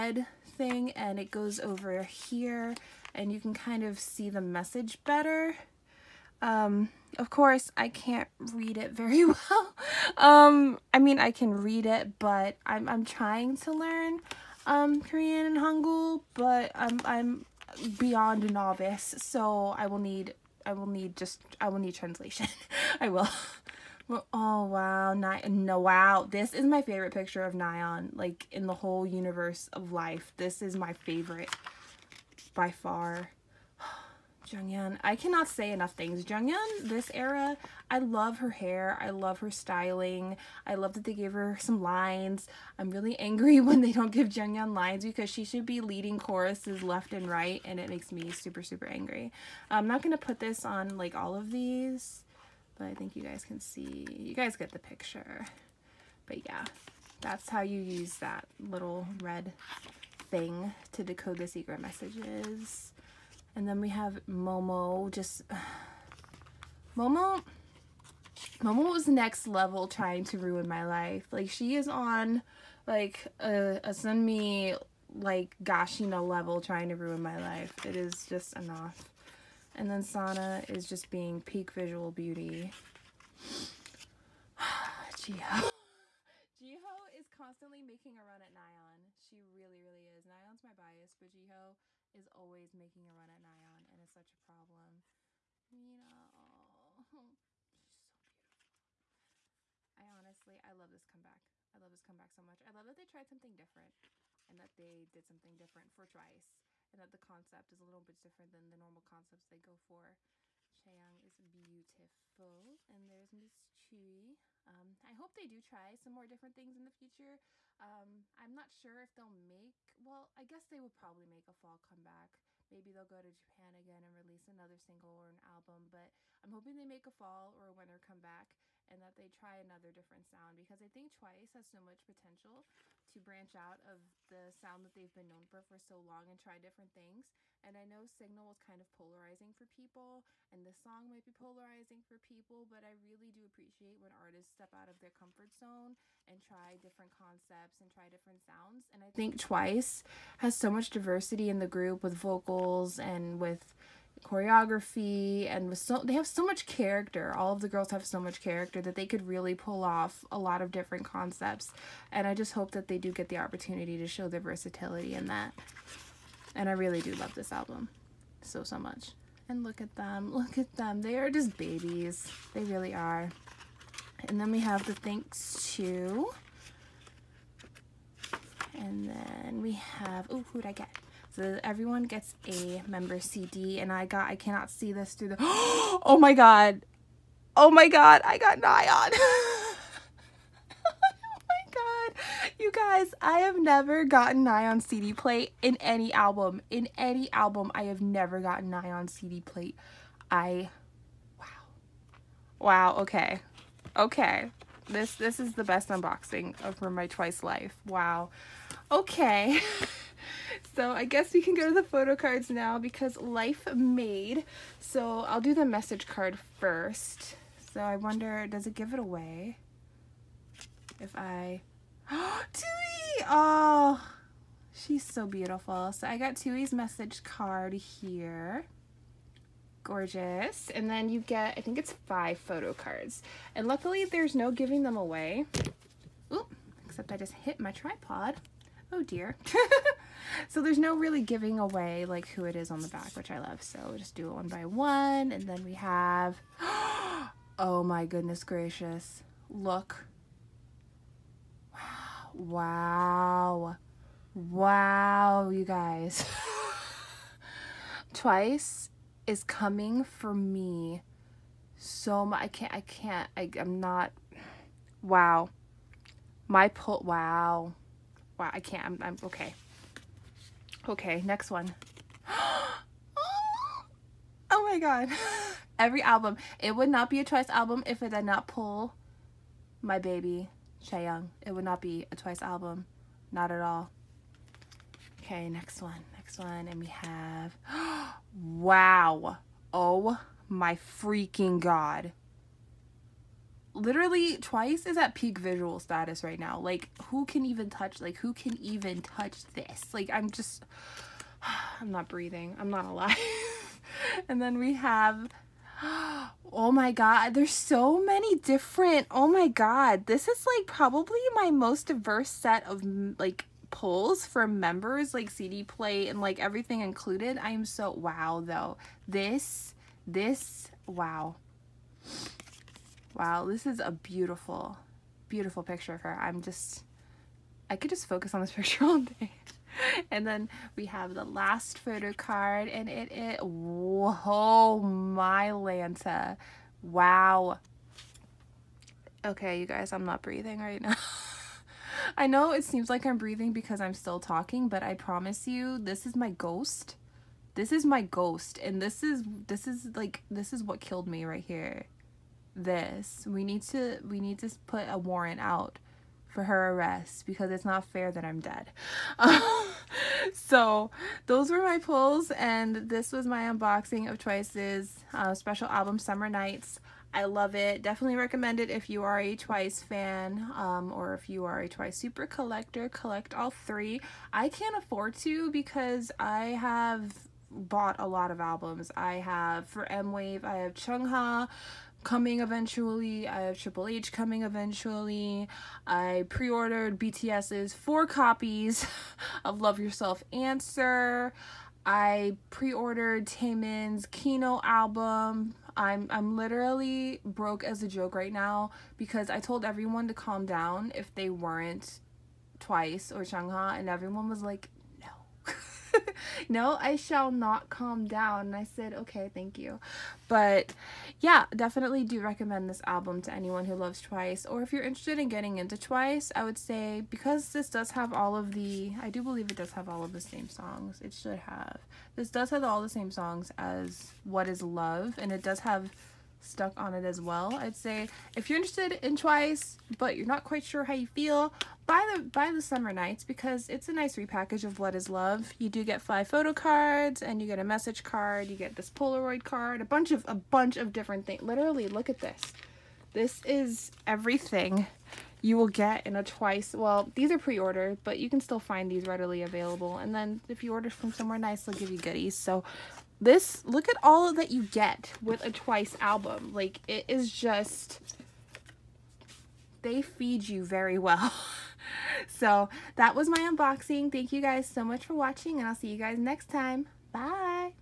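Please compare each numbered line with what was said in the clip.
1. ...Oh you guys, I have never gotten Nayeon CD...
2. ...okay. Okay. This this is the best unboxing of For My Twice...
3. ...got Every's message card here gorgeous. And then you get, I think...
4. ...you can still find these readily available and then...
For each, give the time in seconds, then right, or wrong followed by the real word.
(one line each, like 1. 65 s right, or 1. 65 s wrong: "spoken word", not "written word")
1. 191 s right
2. 203 s right
3. 226 s wrong: "Tzuyu", not "Every"
4. 448 s right.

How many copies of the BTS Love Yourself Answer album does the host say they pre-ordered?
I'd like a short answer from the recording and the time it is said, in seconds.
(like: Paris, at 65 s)
4, at 387 s.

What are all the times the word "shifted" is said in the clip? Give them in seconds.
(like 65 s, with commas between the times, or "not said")
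not said.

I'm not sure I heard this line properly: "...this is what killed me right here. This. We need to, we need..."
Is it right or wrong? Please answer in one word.
right.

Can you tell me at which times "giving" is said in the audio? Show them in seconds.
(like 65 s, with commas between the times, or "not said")
234 s, 241 s.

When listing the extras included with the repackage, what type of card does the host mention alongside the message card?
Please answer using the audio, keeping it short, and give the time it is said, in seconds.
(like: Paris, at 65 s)
Polaroid card, at 438 s.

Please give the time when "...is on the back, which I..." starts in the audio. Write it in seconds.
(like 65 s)
242 s.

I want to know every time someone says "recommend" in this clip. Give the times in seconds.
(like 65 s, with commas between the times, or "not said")
368 s, 412 s.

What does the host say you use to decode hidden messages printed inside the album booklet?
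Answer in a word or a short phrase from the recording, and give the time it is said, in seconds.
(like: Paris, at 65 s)
little red thing, at 58 s.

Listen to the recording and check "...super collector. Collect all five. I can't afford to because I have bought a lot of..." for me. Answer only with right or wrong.
wrong.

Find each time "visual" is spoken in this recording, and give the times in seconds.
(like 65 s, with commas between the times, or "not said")
81 s, 295 s.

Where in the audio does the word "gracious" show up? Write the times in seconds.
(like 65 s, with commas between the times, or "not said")
248 s.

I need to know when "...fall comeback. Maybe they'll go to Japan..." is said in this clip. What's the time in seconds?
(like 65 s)
121 s.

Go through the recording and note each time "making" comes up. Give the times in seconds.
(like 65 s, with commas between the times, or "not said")
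87 s, 92 s.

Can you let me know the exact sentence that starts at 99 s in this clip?
I honestly, I love this comeback.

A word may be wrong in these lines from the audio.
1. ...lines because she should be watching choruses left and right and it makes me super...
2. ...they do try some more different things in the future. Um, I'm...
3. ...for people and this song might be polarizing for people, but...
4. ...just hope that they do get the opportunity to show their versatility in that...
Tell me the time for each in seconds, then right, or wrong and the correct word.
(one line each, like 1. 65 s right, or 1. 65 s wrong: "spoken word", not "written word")
1. 44 s wrong: "leading", not "watching"
2. 115 s right
3. 139 s right
4. 162 s right.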